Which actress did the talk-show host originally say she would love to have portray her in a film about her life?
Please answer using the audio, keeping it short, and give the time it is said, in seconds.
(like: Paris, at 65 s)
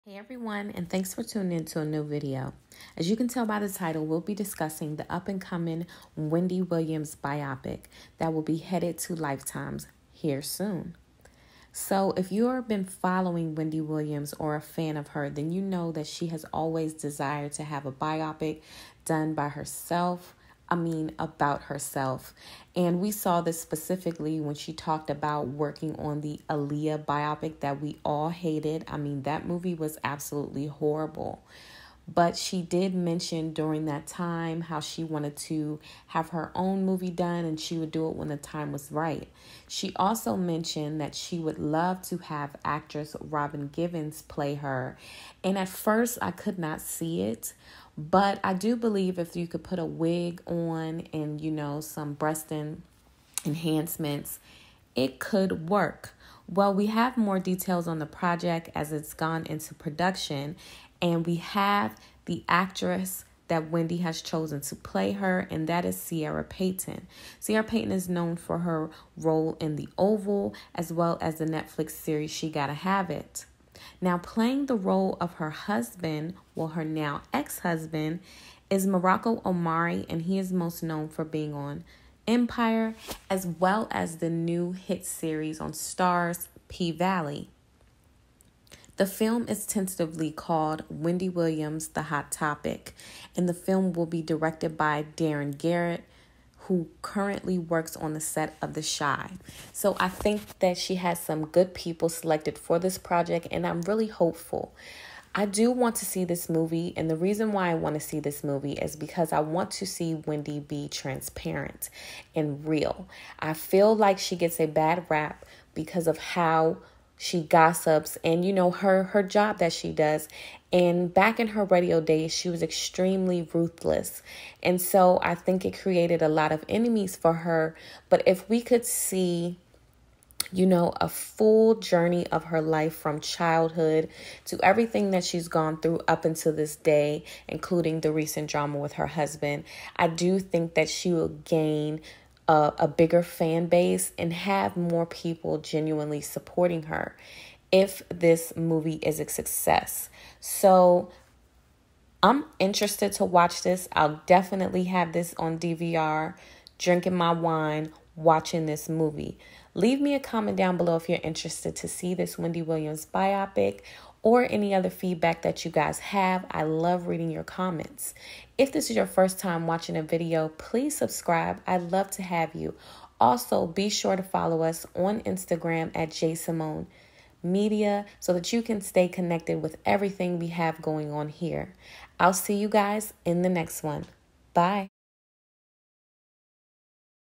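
Robin Givens, at 43 s.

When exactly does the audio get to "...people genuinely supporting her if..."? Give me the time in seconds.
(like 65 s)
145 s.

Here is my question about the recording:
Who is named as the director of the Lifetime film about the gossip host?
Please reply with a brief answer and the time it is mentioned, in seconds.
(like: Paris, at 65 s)
Darren Garrett, at 95 s.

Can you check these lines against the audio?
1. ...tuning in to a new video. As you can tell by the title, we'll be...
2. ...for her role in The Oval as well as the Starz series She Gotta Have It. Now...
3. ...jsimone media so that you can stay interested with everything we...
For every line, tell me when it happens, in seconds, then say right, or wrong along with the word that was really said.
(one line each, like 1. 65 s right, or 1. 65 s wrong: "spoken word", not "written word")
1. 1 s right
2. 68 s wrong: "Netflix", not "Starz"
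3. 176 s wrong: "connected", not "interested".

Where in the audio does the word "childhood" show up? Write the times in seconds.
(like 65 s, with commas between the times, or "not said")
133 s.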